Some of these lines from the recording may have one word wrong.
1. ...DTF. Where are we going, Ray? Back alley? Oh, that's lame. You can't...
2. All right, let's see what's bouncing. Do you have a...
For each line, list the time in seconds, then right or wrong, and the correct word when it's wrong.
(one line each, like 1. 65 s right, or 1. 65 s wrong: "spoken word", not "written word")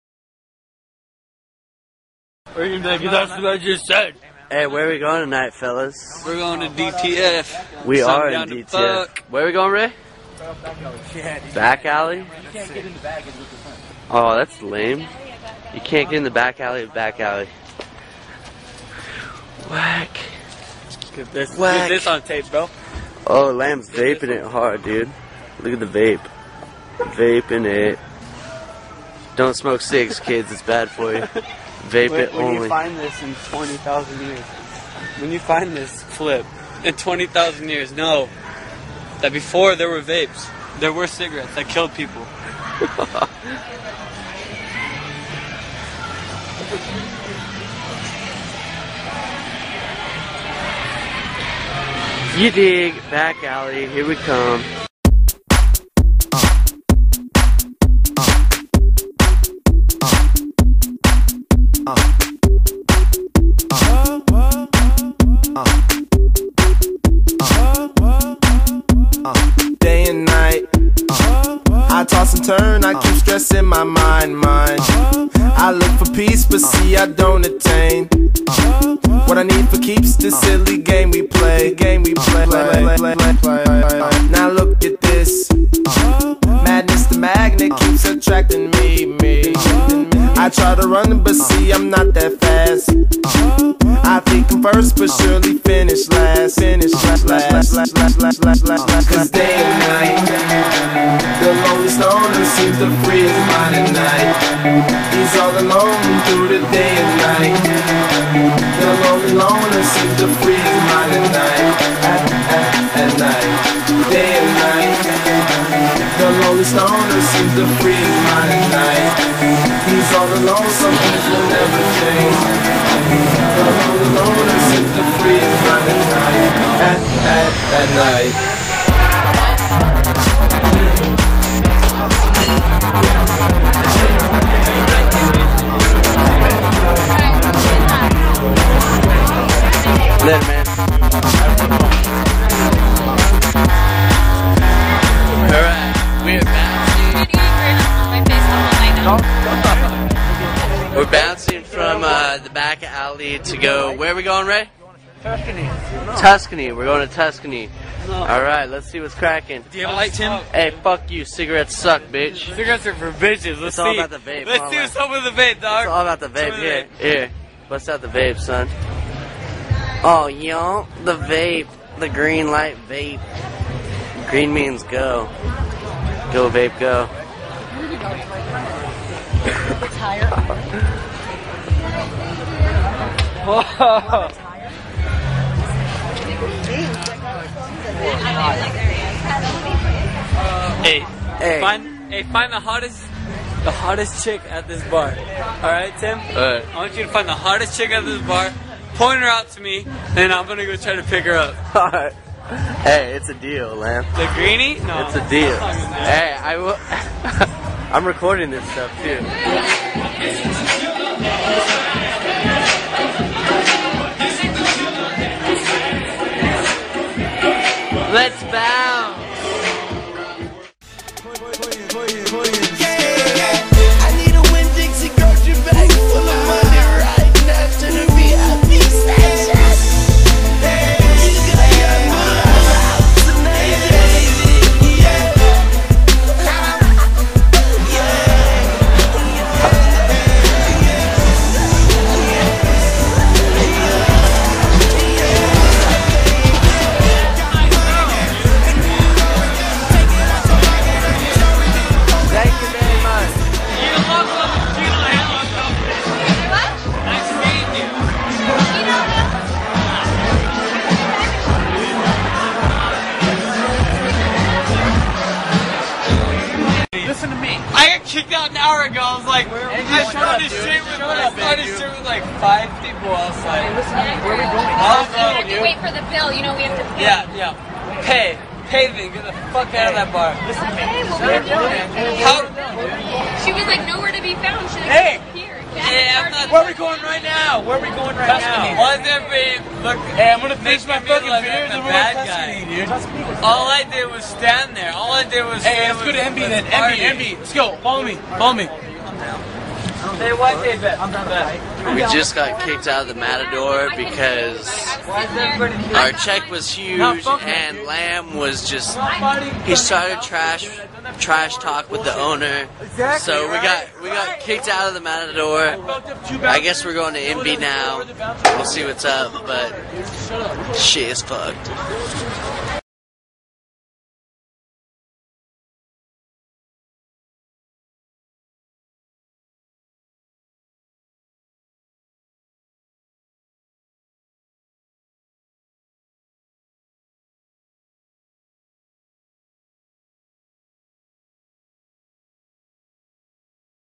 1. 8 s right
2. 158 s wrong: "cracking", not "bouncing".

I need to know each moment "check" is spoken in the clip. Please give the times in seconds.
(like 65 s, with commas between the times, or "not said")
306 s.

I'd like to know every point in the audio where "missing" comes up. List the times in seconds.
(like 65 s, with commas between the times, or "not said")
not said.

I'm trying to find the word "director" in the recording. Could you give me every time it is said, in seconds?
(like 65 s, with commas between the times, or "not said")
not said.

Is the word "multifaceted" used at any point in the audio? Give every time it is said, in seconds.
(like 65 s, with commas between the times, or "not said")
not said.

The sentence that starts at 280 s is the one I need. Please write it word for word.
Okay, well, where are you How?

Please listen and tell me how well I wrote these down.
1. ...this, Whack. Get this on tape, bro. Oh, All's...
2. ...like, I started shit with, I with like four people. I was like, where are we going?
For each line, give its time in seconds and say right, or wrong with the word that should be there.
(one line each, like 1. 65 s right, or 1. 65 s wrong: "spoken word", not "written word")
1. 21 s wrong: "Lamb", not "All"
2. 269 s wrong: "five", not "four".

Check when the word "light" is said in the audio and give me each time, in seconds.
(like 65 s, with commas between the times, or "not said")
159 s, 172 s.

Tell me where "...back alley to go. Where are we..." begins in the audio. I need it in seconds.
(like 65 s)
152 s.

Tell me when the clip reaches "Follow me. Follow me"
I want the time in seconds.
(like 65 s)
297 s.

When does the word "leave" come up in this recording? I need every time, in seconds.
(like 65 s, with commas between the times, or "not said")
not said.